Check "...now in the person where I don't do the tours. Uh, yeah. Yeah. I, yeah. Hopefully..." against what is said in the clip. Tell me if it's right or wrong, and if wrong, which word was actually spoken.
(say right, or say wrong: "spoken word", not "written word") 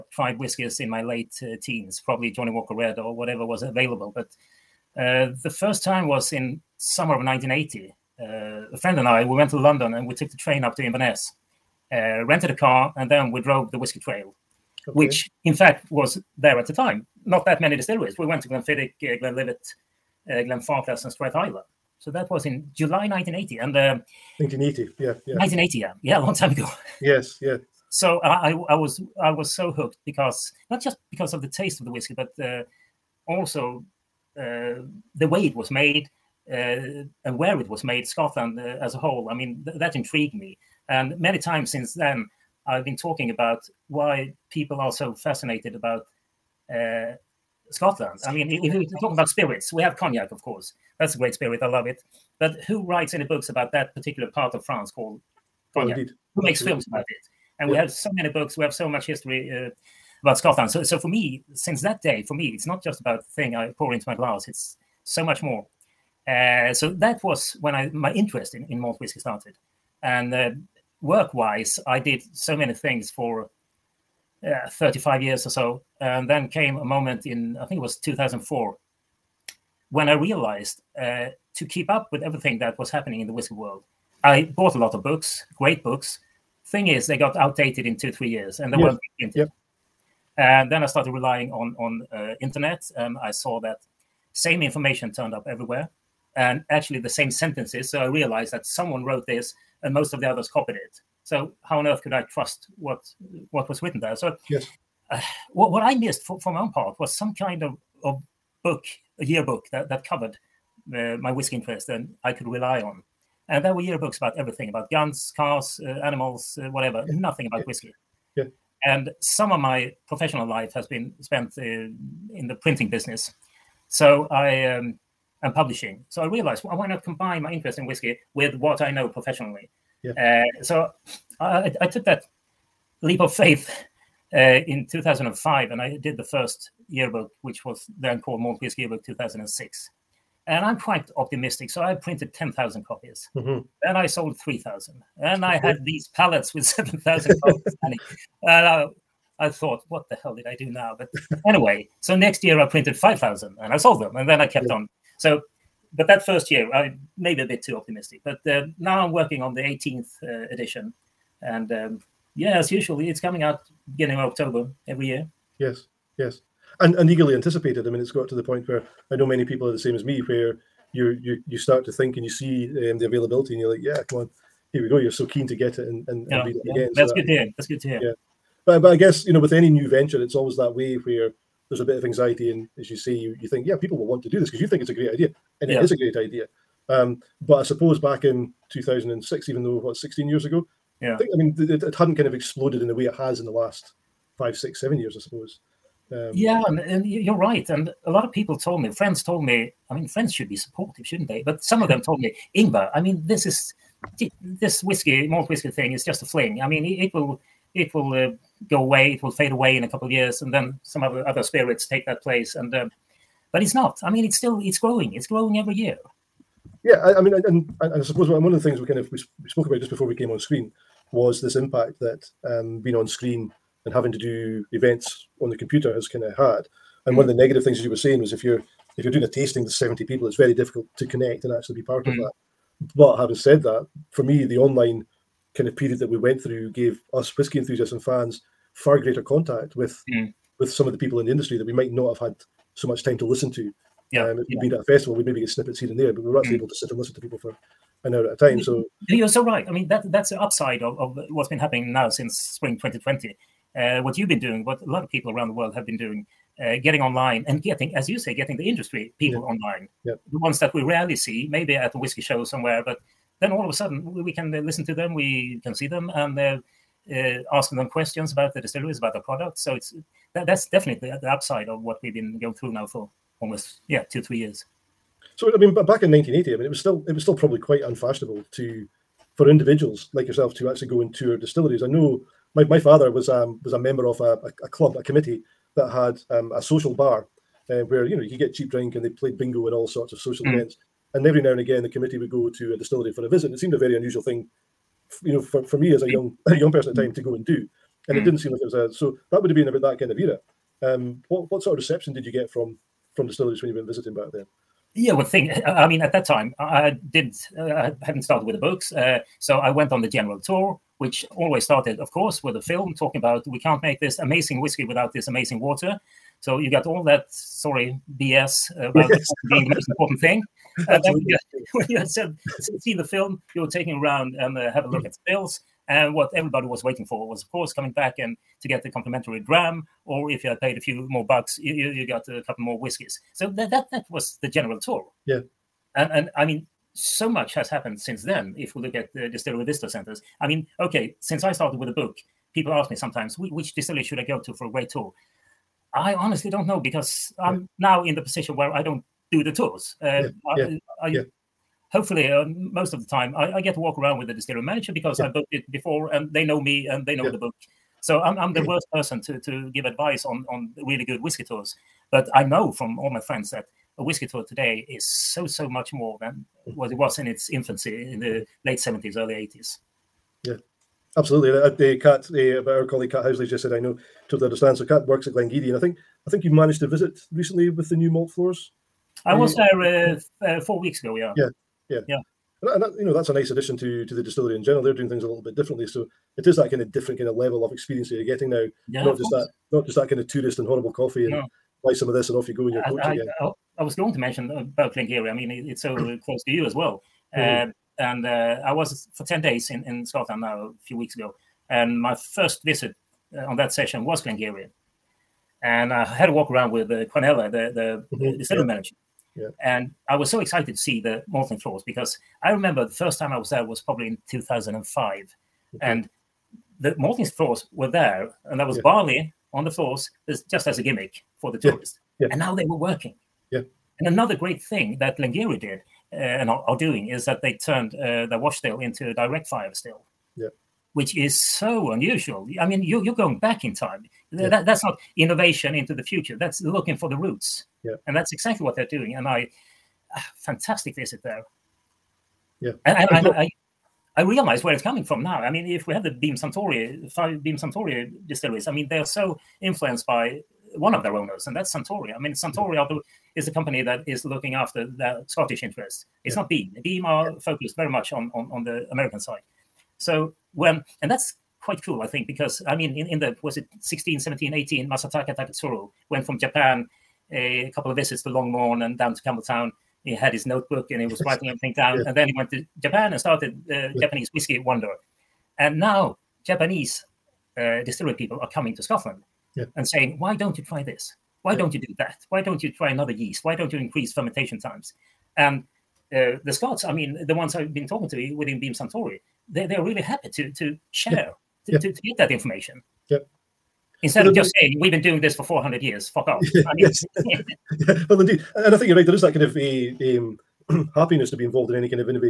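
wrong: "position", not "person".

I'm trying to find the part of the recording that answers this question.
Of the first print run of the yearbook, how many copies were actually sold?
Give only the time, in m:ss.
2:24.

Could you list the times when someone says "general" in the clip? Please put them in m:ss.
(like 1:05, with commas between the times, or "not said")
5:10, 5:34, 6:24.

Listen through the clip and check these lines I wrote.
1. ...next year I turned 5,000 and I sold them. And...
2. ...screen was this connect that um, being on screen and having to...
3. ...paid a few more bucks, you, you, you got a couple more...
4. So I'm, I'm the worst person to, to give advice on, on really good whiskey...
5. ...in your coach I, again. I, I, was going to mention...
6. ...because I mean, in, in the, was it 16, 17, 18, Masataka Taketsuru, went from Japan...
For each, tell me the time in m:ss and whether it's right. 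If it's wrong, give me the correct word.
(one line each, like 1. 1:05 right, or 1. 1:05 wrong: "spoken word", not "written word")
1. 2:32 wrong: "printed", not "turned"
2. 3:40 wrong: "impact", not "connect"
3. 5:30 right
4. 5:58 right
5. 6:32 right
6. 7:42 right.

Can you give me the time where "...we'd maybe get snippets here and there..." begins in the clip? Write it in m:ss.
4:05.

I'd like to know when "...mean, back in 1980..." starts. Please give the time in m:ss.
4:35.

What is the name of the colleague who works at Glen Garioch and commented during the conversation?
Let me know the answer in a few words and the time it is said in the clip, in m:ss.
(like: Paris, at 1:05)
Cat Housley, at 6:13.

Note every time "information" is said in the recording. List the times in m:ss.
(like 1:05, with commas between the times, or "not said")
1:34, 8:12.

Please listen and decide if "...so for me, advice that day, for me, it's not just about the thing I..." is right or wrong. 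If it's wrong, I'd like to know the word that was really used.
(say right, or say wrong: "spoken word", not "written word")
wrong: "since", not "advice".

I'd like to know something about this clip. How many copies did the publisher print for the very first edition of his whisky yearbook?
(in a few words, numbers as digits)
10,000.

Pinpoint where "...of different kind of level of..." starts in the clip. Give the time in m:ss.
6:26.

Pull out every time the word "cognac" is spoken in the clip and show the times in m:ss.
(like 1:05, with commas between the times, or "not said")
0:49, 0:55.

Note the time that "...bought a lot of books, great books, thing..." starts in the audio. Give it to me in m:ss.
1:24.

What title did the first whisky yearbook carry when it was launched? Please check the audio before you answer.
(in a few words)
Malt Whiskey Yearbook 2006.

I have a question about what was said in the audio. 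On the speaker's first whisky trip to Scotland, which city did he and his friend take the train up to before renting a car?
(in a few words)
Inverness.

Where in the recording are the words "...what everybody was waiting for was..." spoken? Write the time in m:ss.
5:26.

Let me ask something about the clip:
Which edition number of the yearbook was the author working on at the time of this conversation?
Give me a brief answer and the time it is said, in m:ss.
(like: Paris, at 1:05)
18th, at 2:39.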